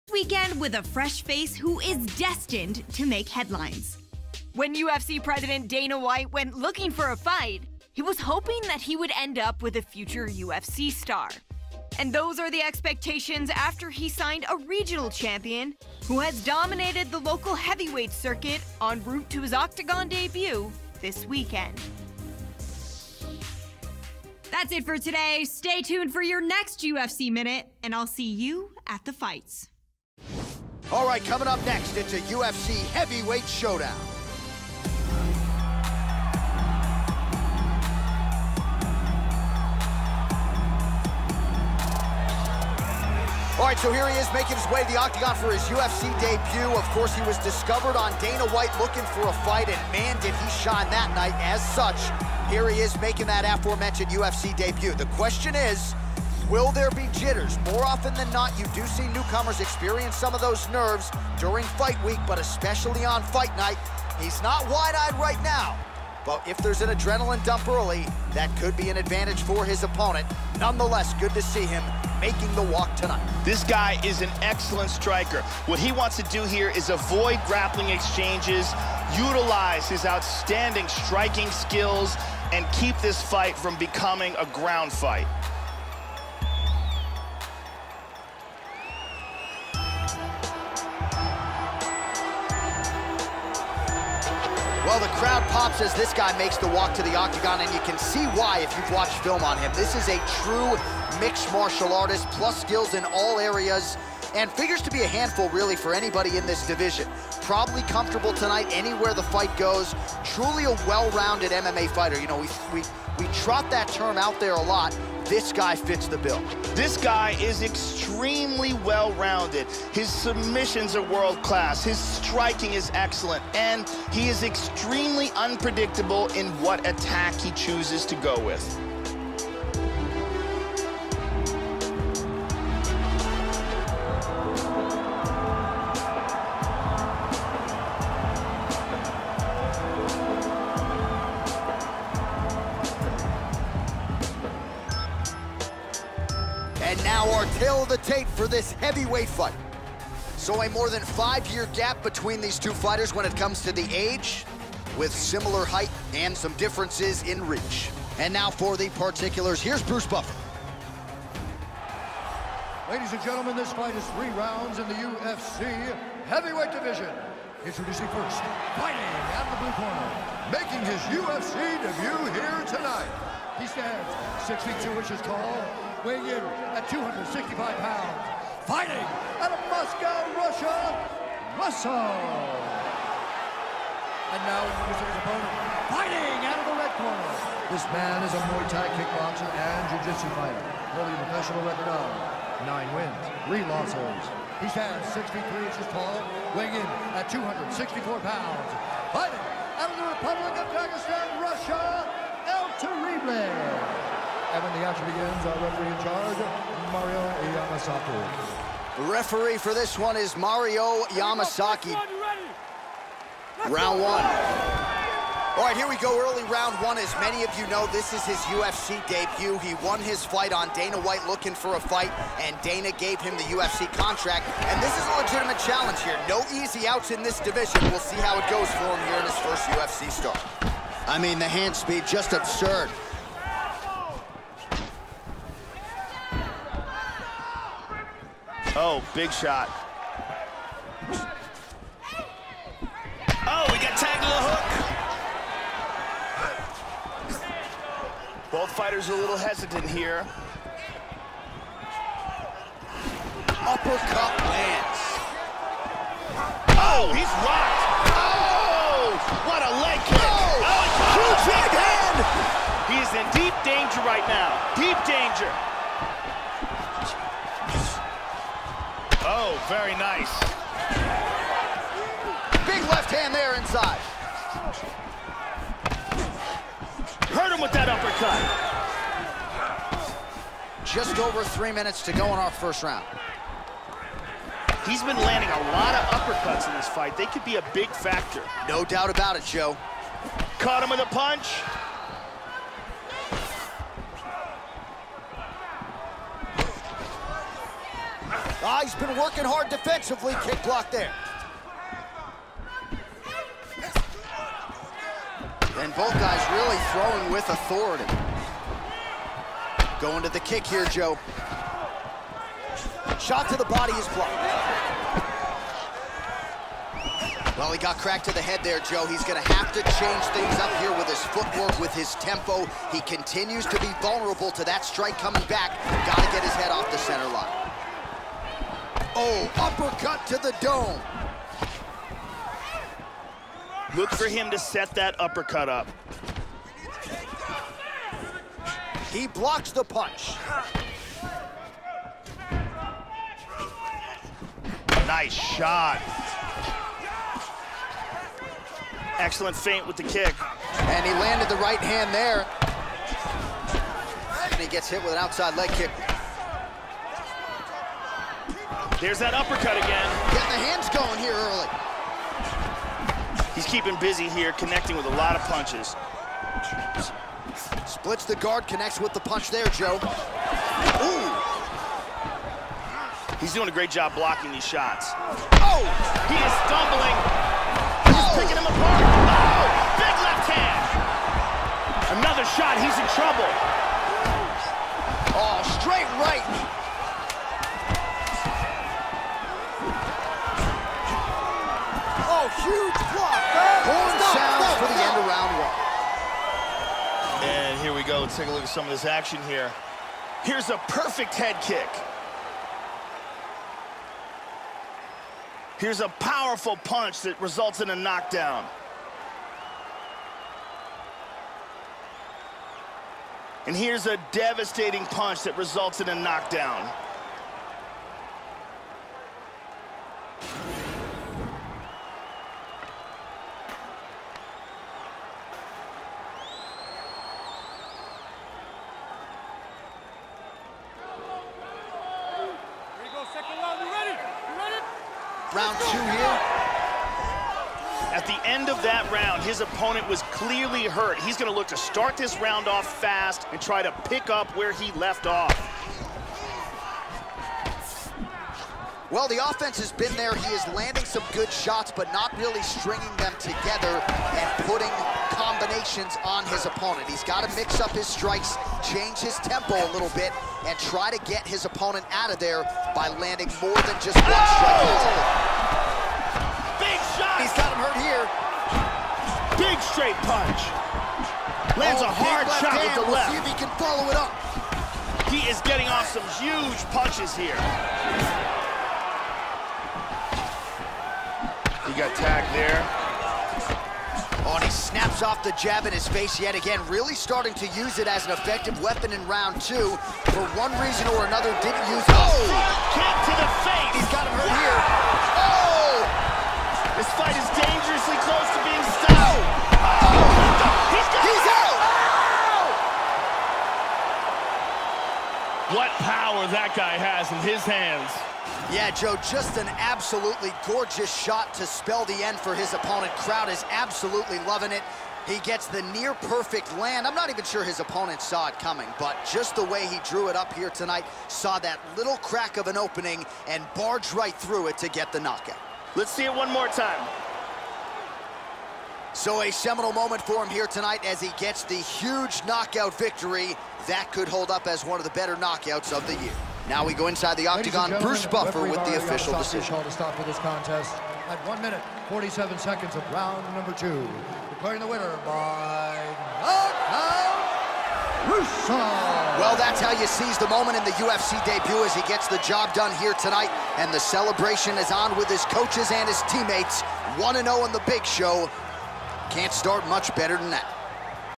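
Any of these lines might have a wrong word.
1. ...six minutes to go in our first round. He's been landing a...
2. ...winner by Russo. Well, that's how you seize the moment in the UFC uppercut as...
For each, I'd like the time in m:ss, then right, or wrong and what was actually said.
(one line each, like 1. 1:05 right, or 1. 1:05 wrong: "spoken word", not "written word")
1. 4:41 wrong: "three", not "six"
2. 9:04 wrong: "debut", not "uppercut".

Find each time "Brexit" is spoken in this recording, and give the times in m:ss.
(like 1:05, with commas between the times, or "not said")
not said.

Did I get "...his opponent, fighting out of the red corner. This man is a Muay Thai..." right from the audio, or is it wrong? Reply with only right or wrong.
right.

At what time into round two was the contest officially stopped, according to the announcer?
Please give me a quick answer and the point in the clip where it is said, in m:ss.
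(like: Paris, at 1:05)
1 minute 47 seconds, at 9:01.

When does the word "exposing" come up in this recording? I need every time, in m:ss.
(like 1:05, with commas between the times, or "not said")
not said.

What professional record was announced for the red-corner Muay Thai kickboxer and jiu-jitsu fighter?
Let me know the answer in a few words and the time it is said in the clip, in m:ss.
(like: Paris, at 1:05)
9 wins, 3 losses, at 3:12.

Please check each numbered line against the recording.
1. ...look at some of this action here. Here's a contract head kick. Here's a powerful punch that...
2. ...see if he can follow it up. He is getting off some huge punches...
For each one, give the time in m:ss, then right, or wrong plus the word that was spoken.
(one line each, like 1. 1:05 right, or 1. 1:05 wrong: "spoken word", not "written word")
1. 6:38 wrong: "perfect", not "contract"
2. 7:53 right.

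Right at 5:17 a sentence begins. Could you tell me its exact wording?
Well, he got cracked to the head there, Joe.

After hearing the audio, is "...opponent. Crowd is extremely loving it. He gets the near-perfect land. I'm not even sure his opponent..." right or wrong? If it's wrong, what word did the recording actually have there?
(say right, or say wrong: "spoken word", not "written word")
wrong: "absolutely", not "extremely".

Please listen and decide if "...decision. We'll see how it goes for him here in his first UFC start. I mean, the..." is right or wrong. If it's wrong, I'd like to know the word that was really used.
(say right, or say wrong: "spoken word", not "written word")
wrong: "division", not "decision".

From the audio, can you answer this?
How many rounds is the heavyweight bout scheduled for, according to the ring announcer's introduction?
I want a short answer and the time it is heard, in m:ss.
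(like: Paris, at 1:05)
3, at 2:44.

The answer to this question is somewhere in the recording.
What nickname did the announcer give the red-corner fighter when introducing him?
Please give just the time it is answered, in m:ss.
3:22.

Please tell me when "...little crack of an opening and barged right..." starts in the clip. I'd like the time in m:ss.
8:41.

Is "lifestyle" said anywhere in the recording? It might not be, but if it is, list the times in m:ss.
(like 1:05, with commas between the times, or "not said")
not said.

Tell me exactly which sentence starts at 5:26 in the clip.
Got to get his head off the center line oh uppercut to the dome.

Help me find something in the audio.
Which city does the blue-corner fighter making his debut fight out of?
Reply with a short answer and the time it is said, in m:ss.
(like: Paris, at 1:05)
Moscow, at 2:59.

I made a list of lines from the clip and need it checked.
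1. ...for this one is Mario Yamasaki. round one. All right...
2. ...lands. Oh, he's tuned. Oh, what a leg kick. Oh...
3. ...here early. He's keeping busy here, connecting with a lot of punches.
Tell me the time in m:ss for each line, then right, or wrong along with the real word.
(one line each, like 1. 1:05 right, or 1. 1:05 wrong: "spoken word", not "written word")
1. 3:29 right
2. 4:14 wrong: "rocked", not "tuned"
3. 6:01 right.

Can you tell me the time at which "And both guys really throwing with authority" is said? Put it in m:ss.
5:05.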